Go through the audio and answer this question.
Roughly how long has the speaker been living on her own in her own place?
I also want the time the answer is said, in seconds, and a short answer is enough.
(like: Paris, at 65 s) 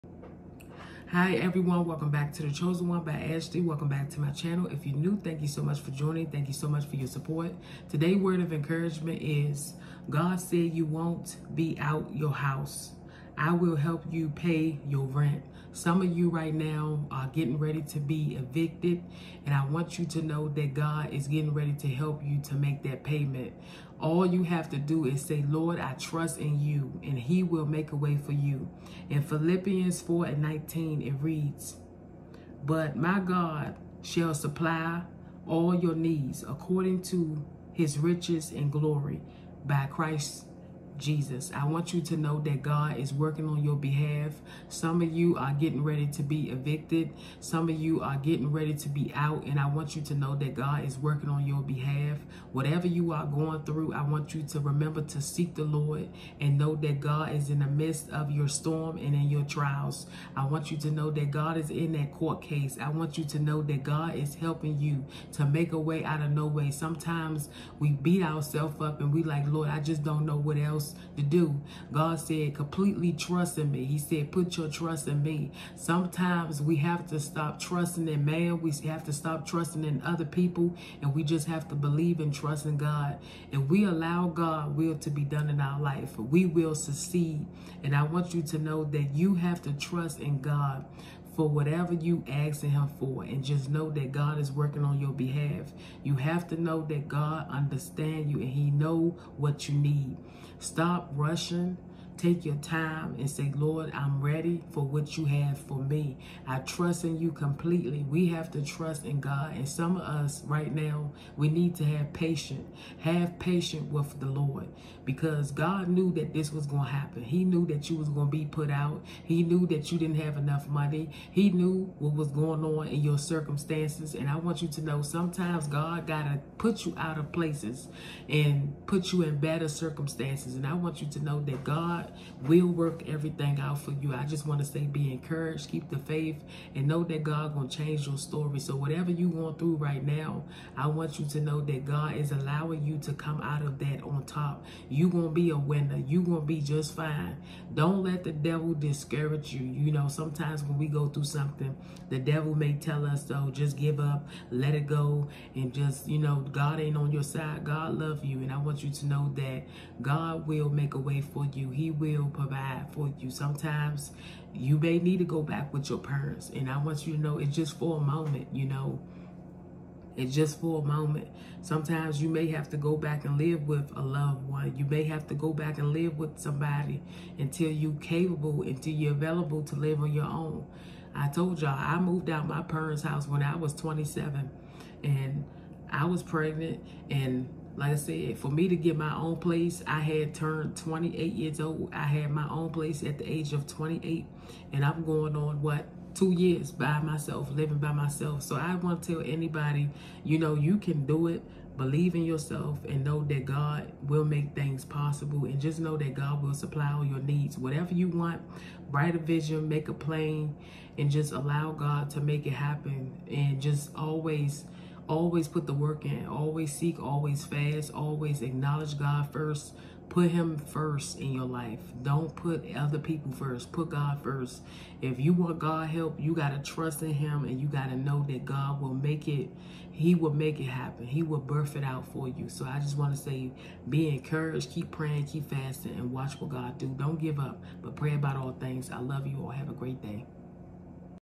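2 years, at 196 s.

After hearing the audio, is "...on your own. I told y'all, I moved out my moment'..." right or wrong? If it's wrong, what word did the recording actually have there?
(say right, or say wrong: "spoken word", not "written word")
wrong: "parents", not "moment".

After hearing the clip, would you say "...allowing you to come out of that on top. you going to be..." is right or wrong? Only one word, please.
right.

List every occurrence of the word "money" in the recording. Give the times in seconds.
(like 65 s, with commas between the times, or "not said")
120 s.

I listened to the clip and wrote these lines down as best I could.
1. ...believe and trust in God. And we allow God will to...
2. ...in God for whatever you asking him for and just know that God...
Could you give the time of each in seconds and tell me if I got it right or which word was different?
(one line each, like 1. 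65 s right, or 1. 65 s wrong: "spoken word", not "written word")
1. 81 s right
2. 90 s right.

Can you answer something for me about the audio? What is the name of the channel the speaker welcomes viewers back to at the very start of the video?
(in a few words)
The Chosen One.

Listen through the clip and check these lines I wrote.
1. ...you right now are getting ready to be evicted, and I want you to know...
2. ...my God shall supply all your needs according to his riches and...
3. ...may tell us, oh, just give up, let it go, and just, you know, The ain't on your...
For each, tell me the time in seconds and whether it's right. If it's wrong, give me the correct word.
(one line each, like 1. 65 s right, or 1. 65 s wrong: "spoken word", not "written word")
1. 16 s right
2. 32 s right
3. 152 s wrong: "God", not "The".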